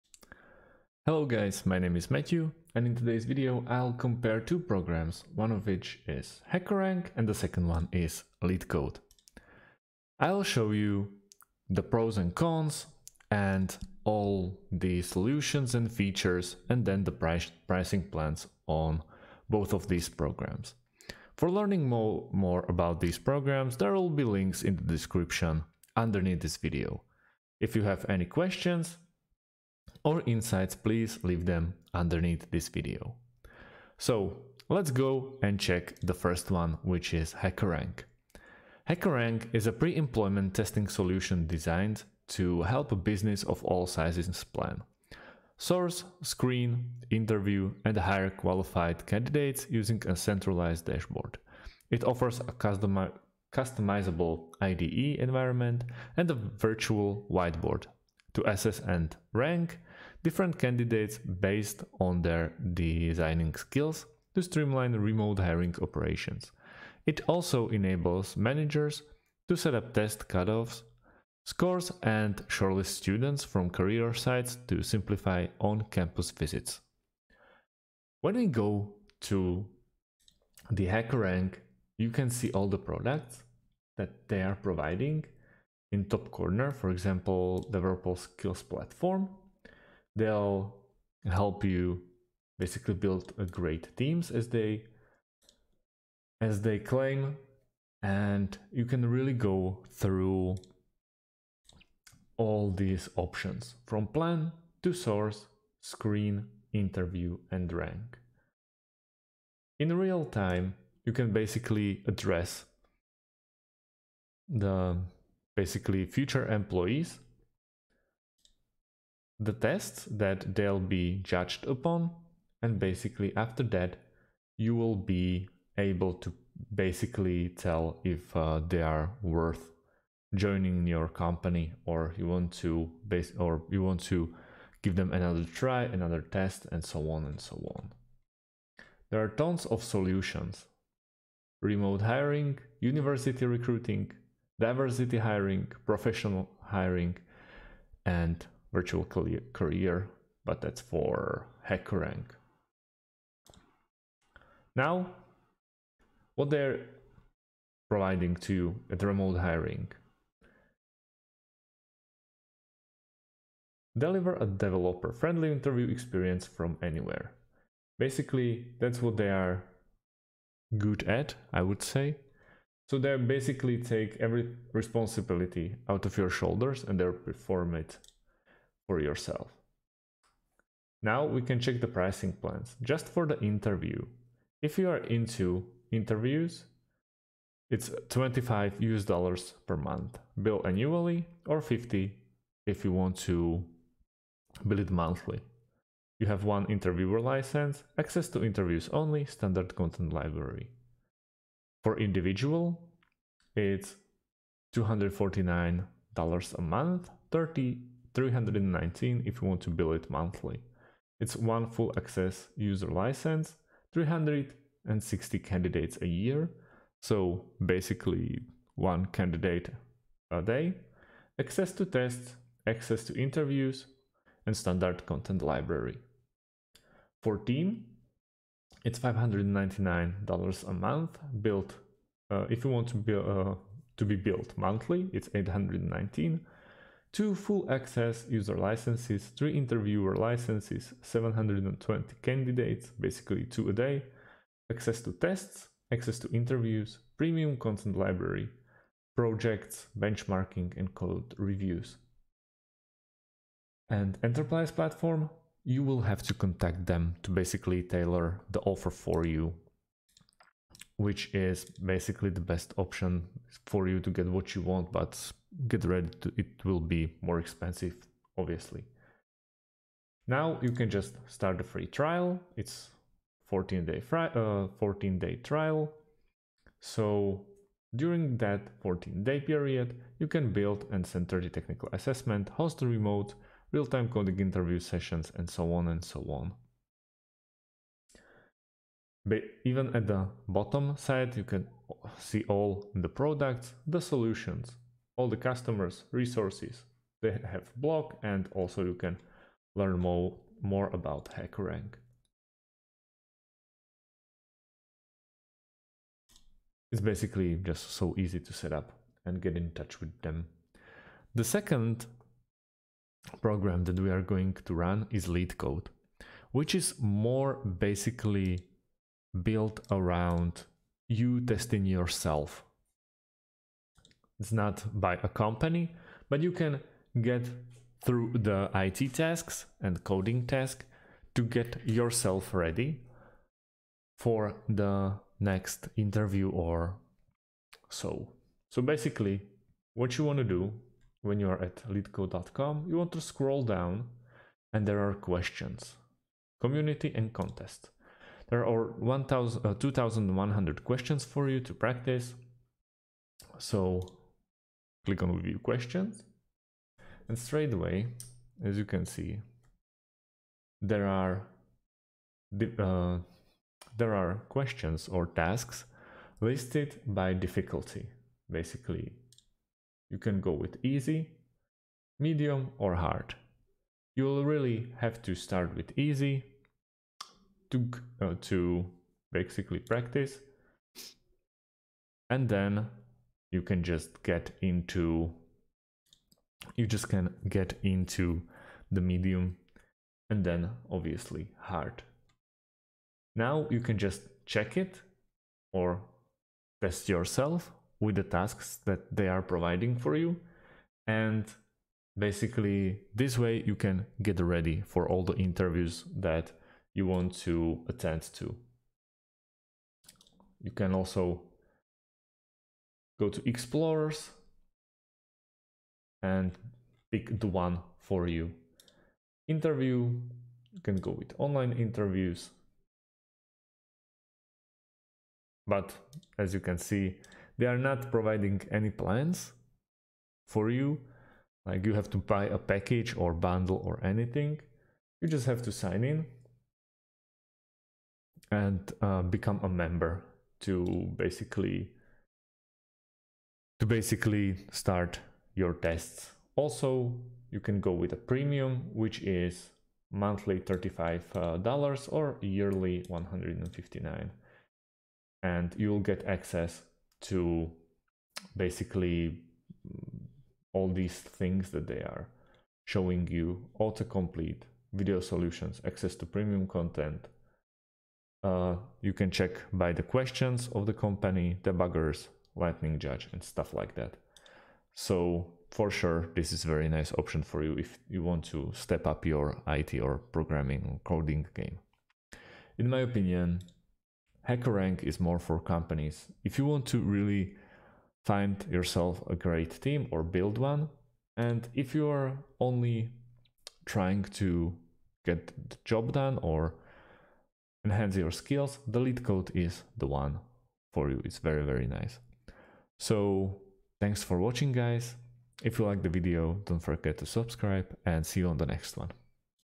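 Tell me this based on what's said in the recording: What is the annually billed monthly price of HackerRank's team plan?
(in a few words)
$599.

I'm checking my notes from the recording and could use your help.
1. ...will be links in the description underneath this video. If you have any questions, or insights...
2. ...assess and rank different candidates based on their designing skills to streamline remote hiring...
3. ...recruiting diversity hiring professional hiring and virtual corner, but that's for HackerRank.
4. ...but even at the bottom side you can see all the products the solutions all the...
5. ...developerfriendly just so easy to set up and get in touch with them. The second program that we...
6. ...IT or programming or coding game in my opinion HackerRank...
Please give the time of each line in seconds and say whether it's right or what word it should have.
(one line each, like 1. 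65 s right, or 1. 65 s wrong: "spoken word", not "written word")
1. 23 s right
2. 58 s right
3. 143 s wrong: "career", not "corner"
4. 289 s right
5. 307 s wrong: "basically", not "developerfriendly"
6. 479 s right.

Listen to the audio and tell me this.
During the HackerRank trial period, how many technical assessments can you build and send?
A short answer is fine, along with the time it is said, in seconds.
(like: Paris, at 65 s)
30, at 281 s.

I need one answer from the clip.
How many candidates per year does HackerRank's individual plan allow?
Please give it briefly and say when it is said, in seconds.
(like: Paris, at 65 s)
360, at 213 s.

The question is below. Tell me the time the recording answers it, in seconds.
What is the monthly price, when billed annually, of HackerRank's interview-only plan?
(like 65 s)
188 s.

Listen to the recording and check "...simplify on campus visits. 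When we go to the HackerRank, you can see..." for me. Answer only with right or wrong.
right.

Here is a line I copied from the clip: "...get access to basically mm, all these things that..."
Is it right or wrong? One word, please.
right.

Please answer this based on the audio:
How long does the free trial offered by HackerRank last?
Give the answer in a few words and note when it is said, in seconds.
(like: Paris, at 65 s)
14 days, at 274 s.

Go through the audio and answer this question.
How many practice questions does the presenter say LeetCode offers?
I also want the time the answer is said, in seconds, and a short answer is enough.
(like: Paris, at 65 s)
2100, at 349 s.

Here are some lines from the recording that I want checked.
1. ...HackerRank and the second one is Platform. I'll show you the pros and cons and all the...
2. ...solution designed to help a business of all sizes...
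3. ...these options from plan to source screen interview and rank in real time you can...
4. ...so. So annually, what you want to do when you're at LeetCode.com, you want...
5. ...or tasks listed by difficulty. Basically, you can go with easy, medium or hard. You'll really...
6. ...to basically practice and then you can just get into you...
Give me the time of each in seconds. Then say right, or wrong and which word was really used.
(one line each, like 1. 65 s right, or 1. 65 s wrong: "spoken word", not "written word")
1. 6 s wrong: "LeetCode", not "Platform"
2. 40 s right
3. 102 s right
4. 337 s wrong: "basically", not "annually"
5. 365 s right
6. 378 s right.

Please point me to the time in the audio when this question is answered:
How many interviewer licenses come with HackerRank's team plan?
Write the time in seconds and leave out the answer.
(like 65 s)
239 s.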